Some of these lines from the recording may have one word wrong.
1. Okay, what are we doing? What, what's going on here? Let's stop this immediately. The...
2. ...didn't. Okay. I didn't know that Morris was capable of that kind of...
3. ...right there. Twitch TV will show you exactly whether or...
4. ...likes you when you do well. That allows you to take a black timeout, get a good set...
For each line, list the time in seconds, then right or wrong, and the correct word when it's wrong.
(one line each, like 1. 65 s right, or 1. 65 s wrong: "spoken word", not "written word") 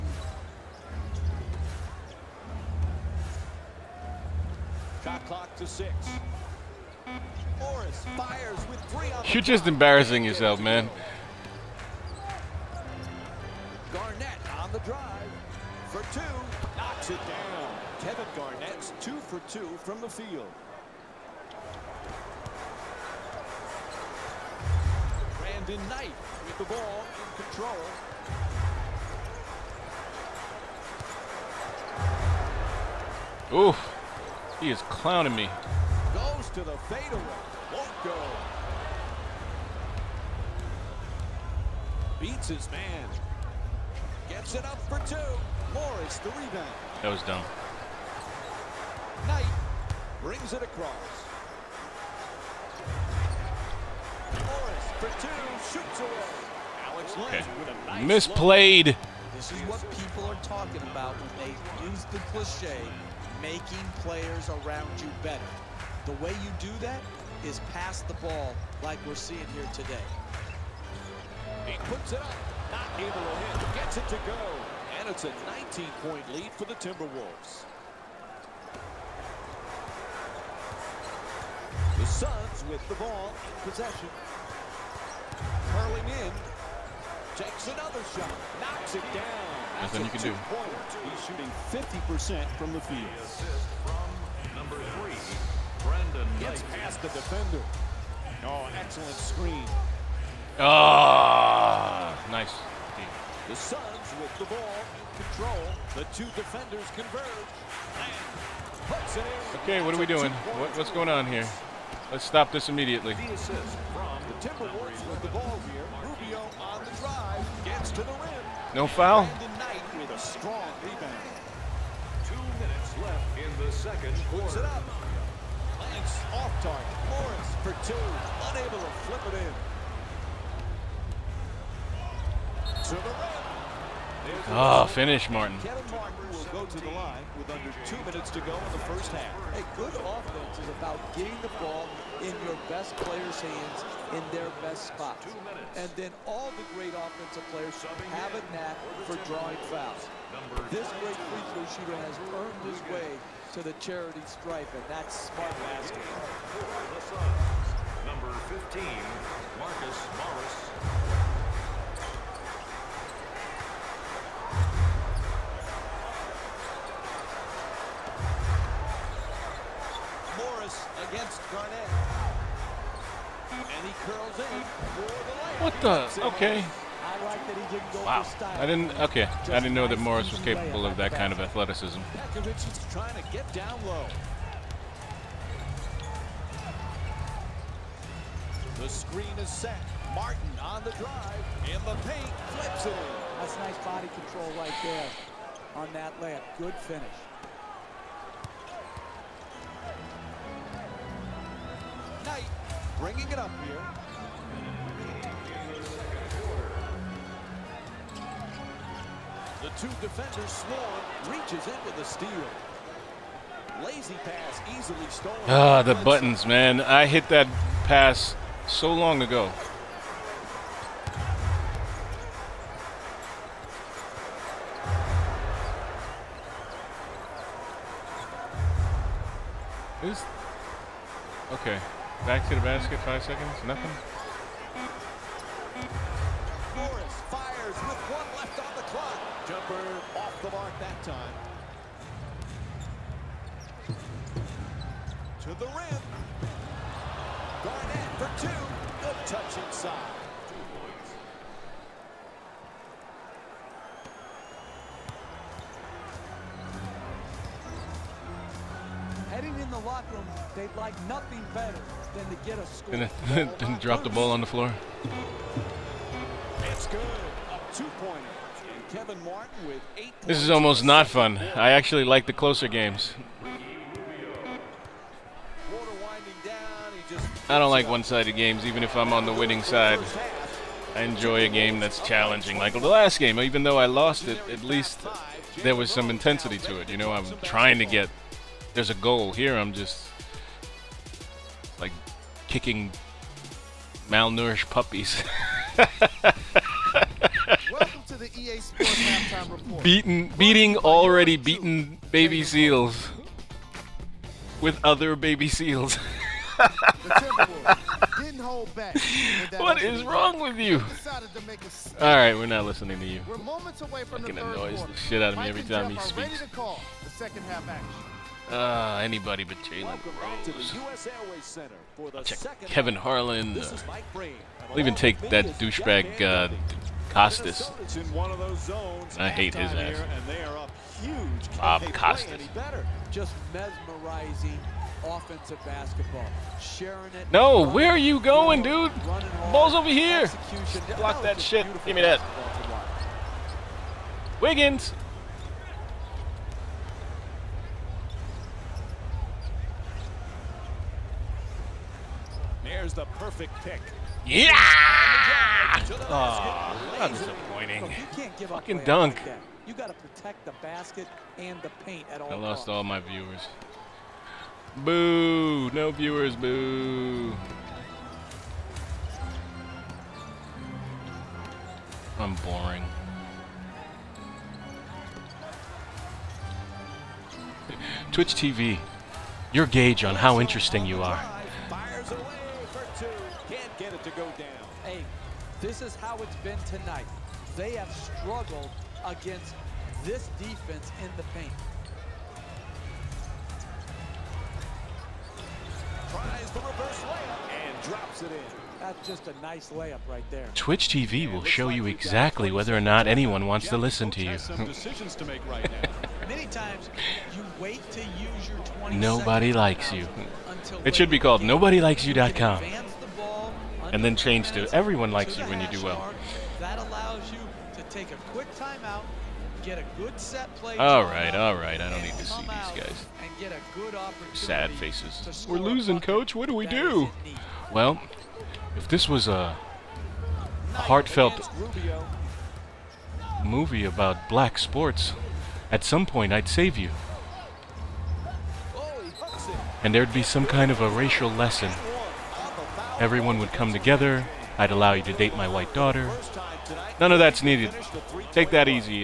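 1. 109 s right
2. 178 s right
3. 400 s right
4. 415 s wrong: "quick", not "black".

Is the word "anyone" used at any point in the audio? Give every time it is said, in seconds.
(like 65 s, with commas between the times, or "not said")
403 s.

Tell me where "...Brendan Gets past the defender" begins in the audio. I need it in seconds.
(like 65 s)
95 s.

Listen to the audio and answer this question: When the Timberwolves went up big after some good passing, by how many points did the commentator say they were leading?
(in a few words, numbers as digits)
19.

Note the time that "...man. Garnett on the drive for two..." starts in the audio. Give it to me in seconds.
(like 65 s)
10 s.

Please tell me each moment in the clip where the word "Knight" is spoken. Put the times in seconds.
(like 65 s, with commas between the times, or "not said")
25 s, 49 s.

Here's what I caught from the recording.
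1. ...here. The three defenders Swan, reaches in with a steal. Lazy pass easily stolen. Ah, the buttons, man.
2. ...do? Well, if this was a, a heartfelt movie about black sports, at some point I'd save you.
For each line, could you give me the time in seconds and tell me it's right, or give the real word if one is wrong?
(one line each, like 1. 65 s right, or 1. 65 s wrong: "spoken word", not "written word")
1. 203 s wrong: "two", not "three"
2. 426 s right.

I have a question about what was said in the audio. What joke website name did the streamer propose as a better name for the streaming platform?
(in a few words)
NobodyLikesYou.com.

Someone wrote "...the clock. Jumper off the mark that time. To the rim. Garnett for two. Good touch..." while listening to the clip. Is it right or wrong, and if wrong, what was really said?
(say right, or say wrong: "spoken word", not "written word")
right.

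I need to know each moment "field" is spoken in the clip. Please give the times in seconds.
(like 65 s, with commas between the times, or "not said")
20 s, 92 s.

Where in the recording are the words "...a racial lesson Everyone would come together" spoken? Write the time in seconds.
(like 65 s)
440 s.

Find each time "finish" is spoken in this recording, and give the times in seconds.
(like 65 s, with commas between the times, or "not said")
134 s, 196 s.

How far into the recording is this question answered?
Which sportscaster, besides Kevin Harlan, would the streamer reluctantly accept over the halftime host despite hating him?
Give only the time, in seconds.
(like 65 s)
331 s.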